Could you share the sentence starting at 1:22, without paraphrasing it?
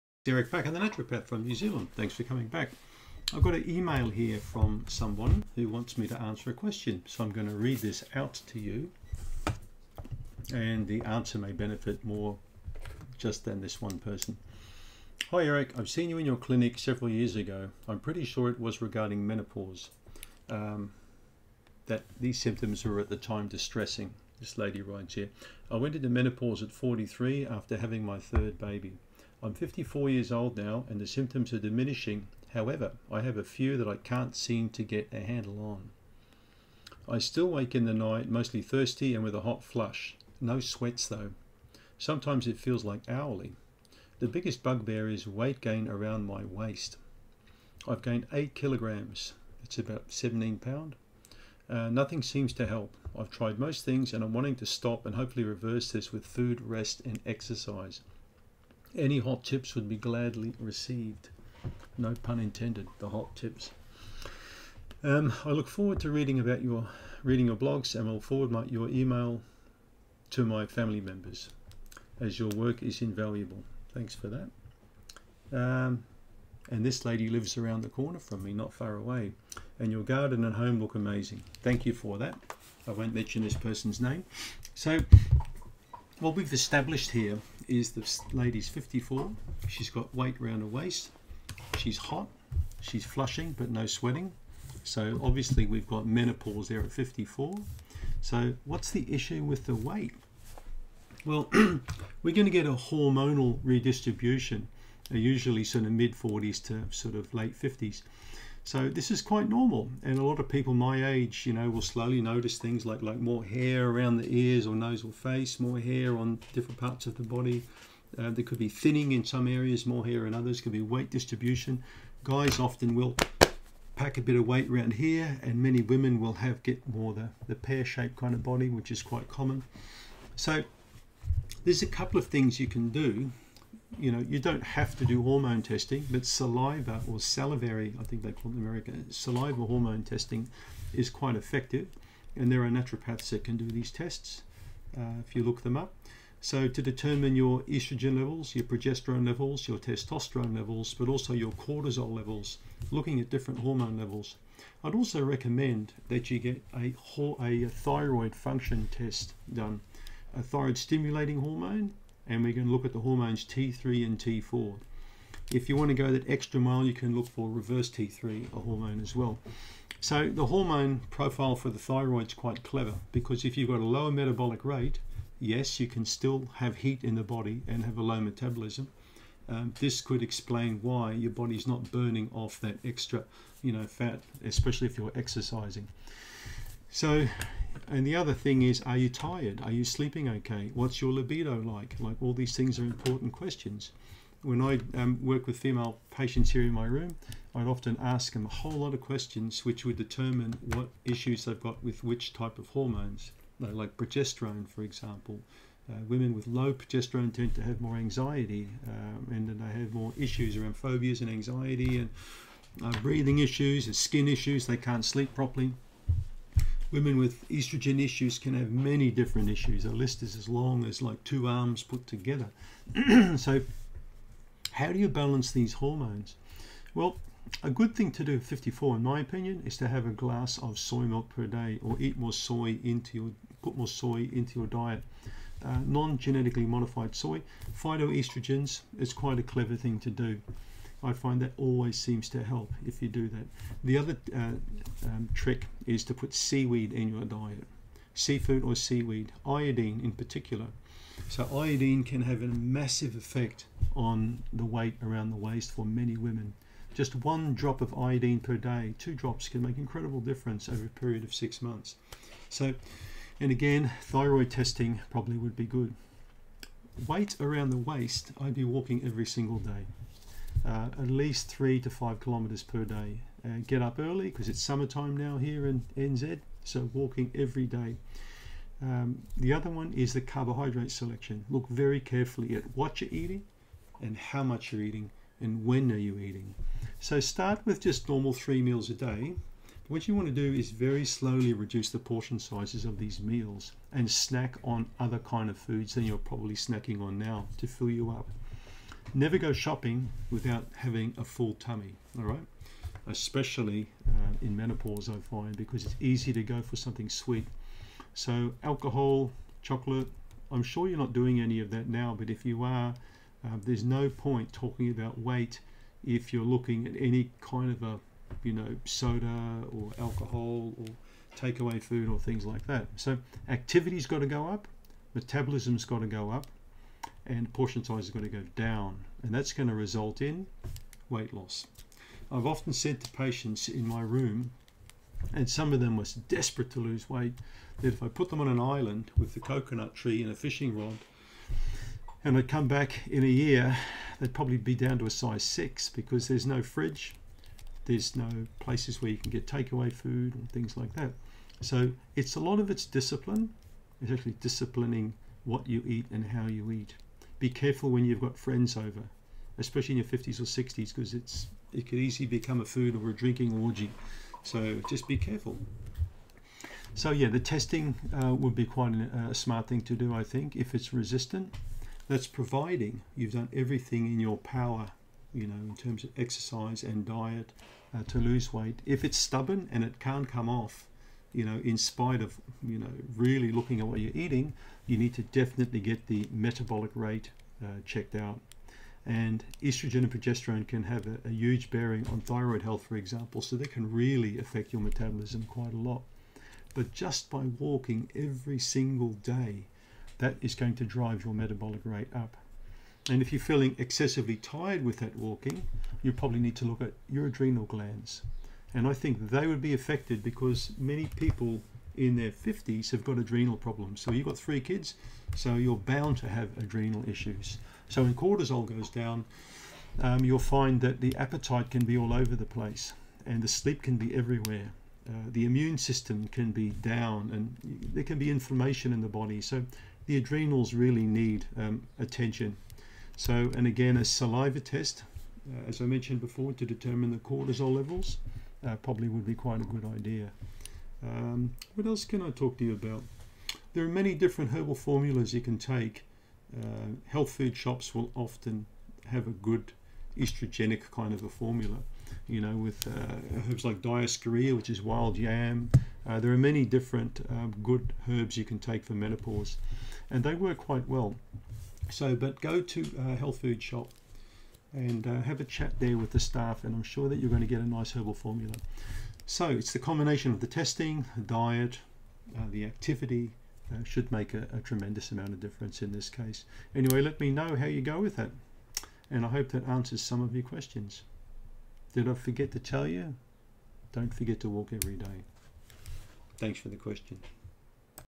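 I won't mention this person's name.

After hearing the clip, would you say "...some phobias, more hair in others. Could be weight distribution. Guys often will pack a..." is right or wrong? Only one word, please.
wrong.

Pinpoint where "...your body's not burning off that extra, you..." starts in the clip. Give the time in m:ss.
3:01.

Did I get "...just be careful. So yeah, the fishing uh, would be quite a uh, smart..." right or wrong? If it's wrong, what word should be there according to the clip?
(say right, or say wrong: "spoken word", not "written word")
wrong: "testing", not "fishing".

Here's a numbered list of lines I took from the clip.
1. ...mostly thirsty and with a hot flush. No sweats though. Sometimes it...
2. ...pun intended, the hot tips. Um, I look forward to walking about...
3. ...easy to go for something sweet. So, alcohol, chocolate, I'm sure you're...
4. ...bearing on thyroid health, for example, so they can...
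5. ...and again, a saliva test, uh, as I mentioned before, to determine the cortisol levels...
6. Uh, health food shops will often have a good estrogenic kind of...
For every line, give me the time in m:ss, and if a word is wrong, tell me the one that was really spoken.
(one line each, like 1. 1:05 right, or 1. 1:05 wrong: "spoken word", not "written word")
1. 0:38 right
2. 1:02 wrong: "reading", not "walking"
3. 5:05 right
4. 6:31 right
5. 7:13 right
6. 7:26 right.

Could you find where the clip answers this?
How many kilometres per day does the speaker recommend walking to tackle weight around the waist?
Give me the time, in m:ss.
4:31.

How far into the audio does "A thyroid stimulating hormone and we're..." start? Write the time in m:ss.
2:40.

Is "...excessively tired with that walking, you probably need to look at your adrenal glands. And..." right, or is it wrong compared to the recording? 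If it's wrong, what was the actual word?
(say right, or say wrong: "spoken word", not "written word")
right.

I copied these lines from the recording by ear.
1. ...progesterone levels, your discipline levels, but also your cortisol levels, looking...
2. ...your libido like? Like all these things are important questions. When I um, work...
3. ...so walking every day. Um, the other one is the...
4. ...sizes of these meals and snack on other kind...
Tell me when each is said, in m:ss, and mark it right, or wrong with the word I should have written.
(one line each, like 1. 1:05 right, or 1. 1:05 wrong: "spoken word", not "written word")
1. 2:28 wrong: "testosterone", not "discipline"
2. 3:11 right
3. 4:36 right
4. 4:52 right.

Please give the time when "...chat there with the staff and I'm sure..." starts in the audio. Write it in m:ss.
7:45.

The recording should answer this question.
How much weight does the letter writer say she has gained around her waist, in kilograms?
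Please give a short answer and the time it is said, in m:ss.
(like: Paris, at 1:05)
8 kilograms, at 0:48.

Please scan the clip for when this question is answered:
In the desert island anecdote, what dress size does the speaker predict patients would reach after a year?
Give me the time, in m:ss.
5:45.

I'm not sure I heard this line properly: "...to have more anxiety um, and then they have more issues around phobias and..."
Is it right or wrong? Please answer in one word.
right.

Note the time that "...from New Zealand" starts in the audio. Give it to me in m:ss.
0:01.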